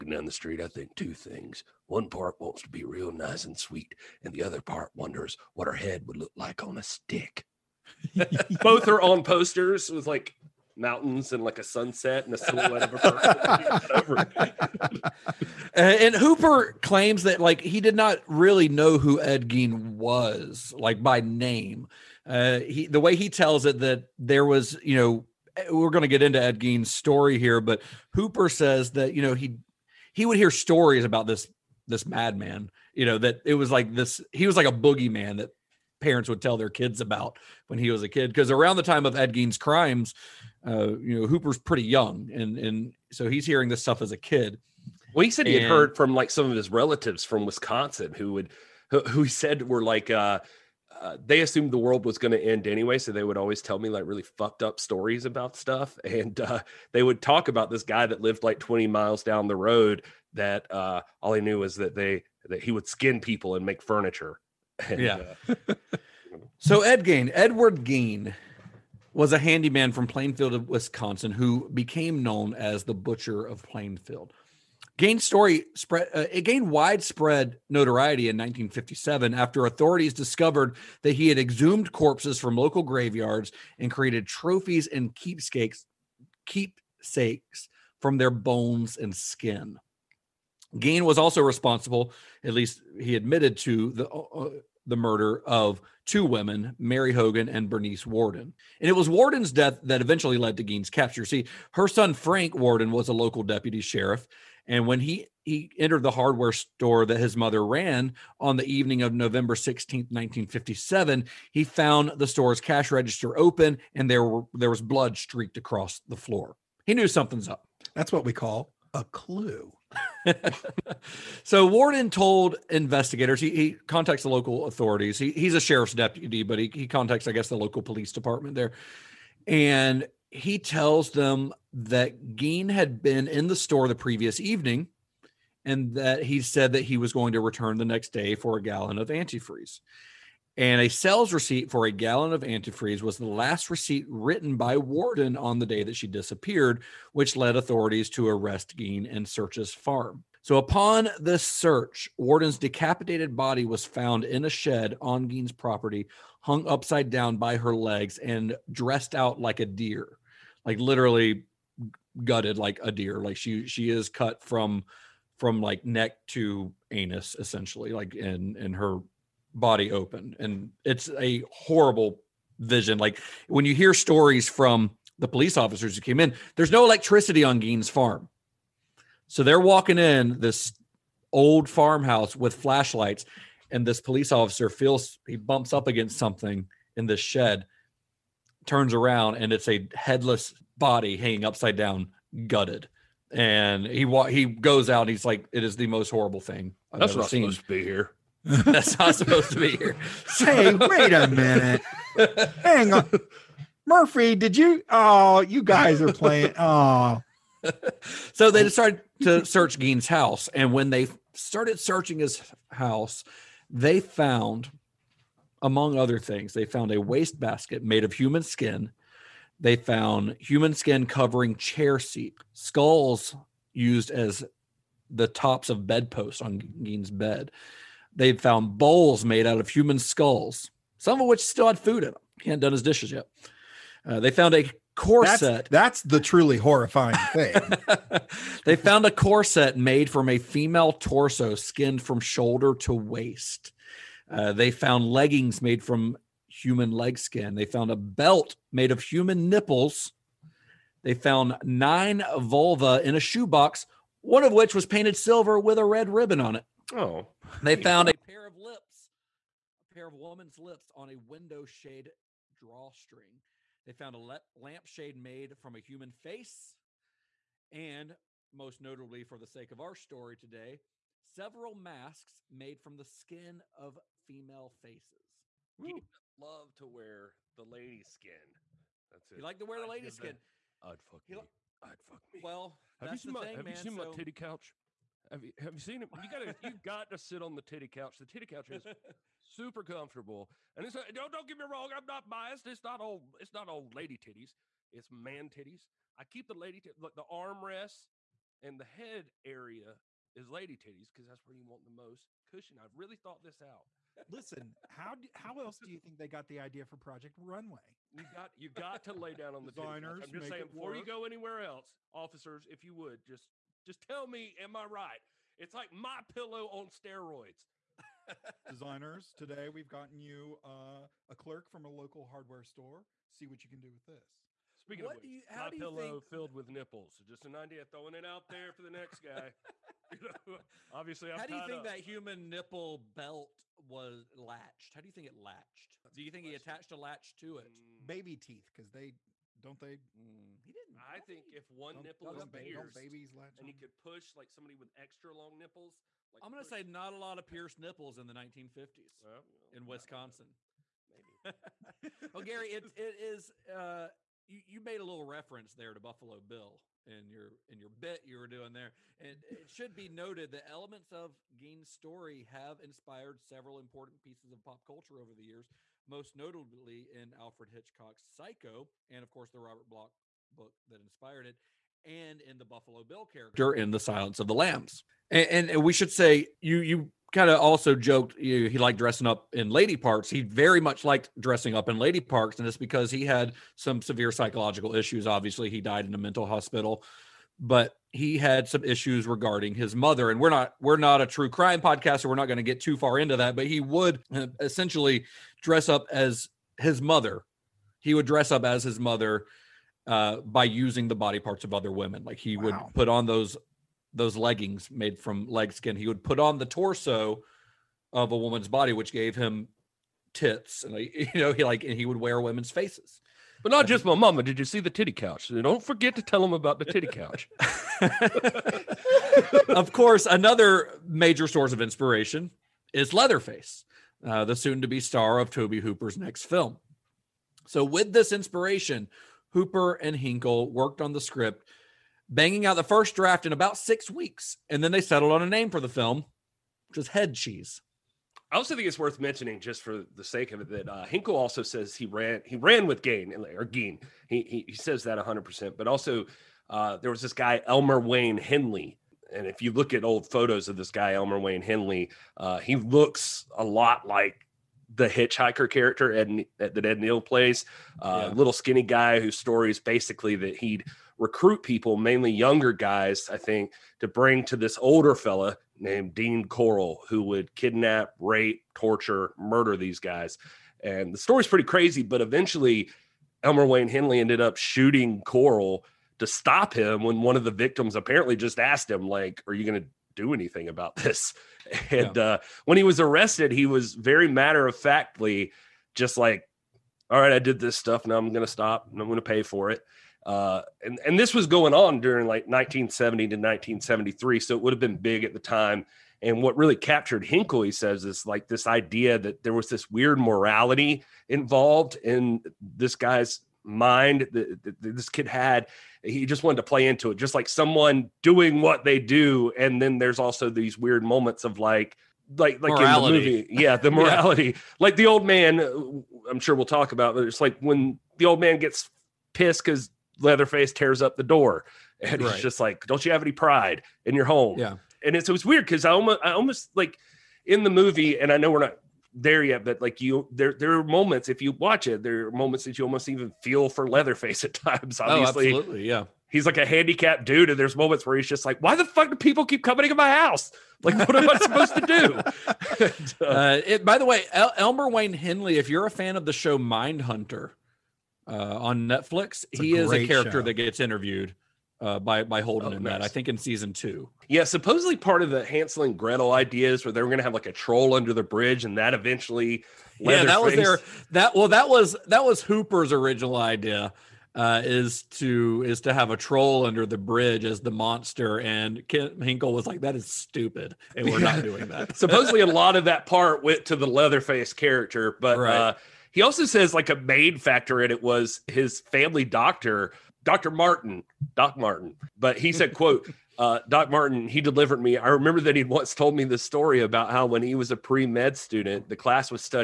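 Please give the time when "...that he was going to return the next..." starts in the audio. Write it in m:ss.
2:16.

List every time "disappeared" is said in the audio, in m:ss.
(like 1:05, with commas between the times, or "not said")
2:26.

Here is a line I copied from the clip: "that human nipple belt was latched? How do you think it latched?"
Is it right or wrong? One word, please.
right.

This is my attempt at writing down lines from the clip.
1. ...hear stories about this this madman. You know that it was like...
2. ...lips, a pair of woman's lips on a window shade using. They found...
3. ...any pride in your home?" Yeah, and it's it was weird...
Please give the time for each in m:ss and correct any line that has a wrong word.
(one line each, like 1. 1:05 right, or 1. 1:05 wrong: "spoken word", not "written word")
1. 0:30 right
2. 4:18 wrong: "drawstring", not "using"
3. 8:43 right.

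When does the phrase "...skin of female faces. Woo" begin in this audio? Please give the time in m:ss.
4:33.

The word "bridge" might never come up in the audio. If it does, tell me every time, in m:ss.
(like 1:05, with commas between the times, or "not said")
9:18, 9:26.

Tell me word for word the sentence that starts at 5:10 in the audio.
you go anywhere else, officers, if you would just just tell me, am I right?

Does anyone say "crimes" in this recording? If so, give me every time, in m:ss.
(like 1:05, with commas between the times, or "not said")
0:39, 6:31.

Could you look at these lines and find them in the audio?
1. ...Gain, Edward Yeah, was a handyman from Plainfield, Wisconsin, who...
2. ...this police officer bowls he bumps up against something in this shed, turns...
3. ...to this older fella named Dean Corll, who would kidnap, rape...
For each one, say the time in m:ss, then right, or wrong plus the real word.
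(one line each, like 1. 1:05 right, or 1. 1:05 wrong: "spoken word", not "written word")
1. 1:07 wrong: "Gain", not "Yeah"
2. 3:03 wrong: "feels", not "bowls"
3. 7:44 right.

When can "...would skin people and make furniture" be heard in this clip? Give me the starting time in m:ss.
1:02.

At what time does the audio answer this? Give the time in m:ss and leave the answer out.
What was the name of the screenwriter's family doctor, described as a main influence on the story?
9:40.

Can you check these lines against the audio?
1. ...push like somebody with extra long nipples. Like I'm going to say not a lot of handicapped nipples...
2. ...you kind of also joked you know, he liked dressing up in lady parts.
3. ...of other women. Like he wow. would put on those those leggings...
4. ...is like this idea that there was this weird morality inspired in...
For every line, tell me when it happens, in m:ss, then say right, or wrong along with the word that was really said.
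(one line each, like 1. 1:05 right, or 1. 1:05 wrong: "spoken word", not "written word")
1. 5:43 wrong: "pierced", not "handicapped"
2. 6:16 right
3. 6:41 right
4. 8:18 wrong: "involved", not "inspired".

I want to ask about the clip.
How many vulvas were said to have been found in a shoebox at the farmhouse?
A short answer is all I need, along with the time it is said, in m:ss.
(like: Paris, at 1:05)
9, at 4:11.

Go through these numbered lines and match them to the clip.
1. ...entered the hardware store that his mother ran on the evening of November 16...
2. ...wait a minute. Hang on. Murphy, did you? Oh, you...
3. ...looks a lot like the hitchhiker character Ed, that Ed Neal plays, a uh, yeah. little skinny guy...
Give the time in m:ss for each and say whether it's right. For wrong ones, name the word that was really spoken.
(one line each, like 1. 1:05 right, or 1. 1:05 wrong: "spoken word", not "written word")
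1. 1:45 right
2. 3:20 right
3. 7:32 right.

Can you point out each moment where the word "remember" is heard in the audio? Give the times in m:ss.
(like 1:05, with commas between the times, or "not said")
9:45.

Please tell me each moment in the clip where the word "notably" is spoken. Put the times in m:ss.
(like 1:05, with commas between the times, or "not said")
4:28, 6:06.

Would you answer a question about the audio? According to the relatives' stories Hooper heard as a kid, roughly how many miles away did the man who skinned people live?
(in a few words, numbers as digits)
20.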